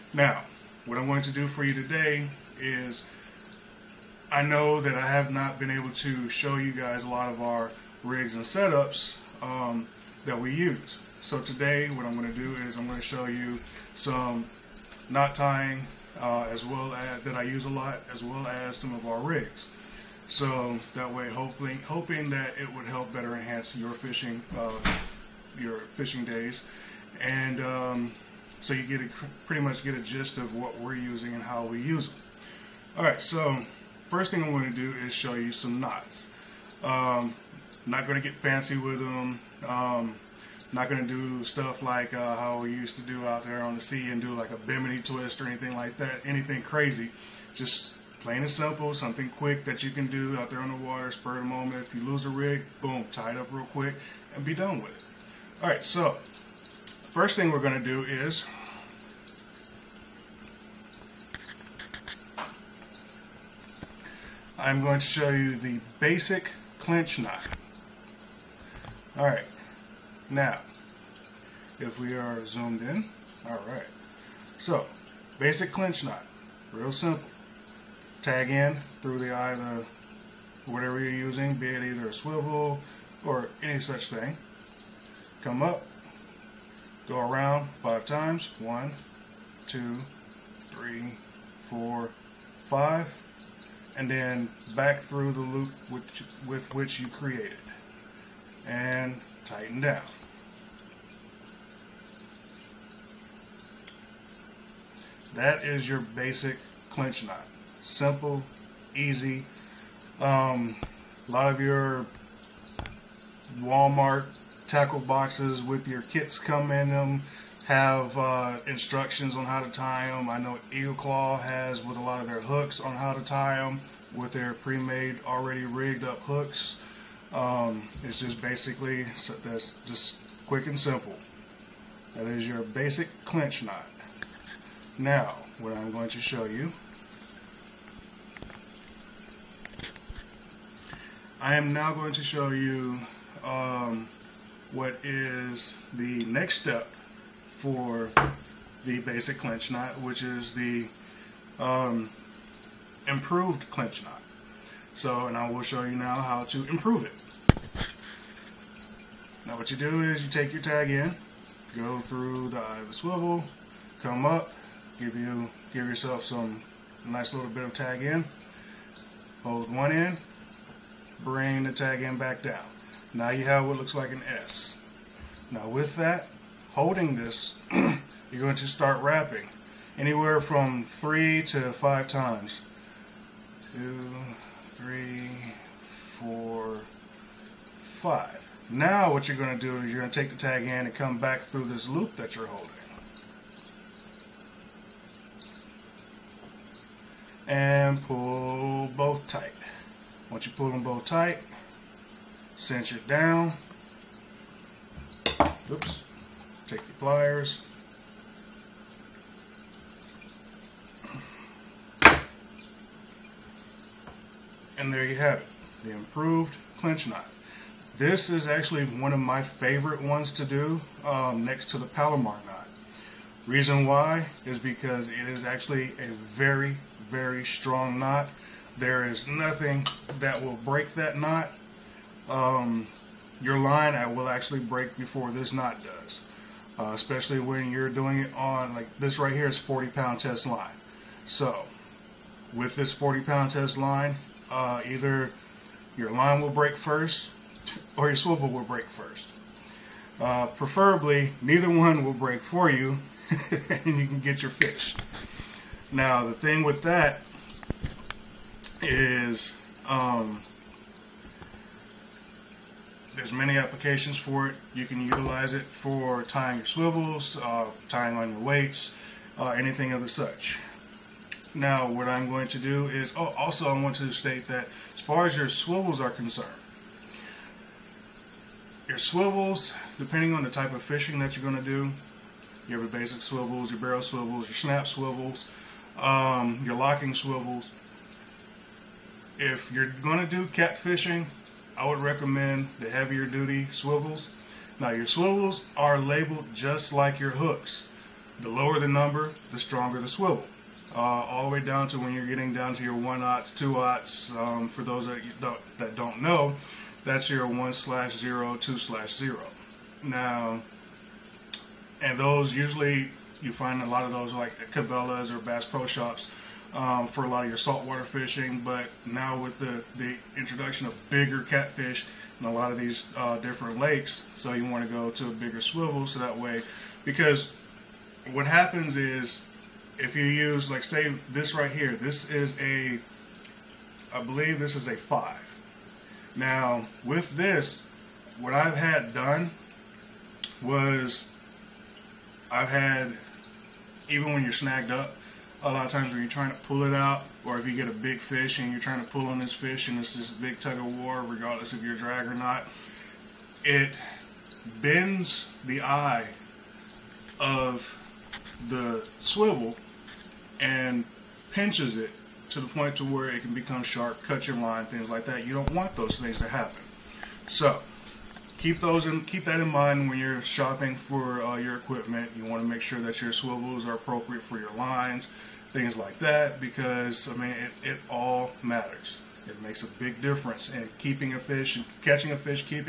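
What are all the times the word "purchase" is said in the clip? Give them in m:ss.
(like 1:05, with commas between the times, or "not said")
not said.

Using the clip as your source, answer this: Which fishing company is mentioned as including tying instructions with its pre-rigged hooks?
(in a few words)
Eagle Claw.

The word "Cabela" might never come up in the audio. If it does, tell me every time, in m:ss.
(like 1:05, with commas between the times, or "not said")
5:14.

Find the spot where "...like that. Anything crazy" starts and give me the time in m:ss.
0:45.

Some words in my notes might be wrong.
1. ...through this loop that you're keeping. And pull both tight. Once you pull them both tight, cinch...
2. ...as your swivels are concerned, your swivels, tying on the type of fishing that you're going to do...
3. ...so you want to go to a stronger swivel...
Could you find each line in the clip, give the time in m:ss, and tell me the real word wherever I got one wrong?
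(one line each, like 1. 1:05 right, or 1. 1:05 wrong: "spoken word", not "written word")
1. 3:11 wrong: "holding", not "keeping"
2. 4:35 wrong: "depending", not "tying"
3. 5:24 wrong: "bigger", not "stronger".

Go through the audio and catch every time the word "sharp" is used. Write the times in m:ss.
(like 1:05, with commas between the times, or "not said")
6:03.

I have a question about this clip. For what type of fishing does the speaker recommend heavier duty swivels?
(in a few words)
Catfishing.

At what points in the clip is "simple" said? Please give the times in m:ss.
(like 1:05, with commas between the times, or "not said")
0:48, 1:16, 1:47, 2:10.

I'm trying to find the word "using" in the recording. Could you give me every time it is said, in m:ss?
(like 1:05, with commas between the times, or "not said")
0:30, 1:21.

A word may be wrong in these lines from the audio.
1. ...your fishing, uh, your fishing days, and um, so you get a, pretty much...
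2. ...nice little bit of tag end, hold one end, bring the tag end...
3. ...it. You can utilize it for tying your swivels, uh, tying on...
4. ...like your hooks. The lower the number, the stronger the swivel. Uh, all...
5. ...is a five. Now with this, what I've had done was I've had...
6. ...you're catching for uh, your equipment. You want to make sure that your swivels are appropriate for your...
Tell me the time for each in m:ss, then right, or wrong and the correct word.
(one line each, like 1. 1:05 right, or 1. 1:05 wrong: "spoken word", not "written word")
1. 0:23 right
2. 2:47 right
3. 4:24 right
4. 4:56 right
5. 5:34 right
6. 6:10 wrong: "shopping", not "catching".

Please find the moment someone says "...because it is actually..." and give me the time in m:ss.
3:44.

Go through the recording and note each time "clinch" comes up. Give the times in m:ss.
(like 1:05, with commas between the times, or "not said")
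1:06, 1:15, 1:46, 2:13, 2:29, 2:33, 3:36.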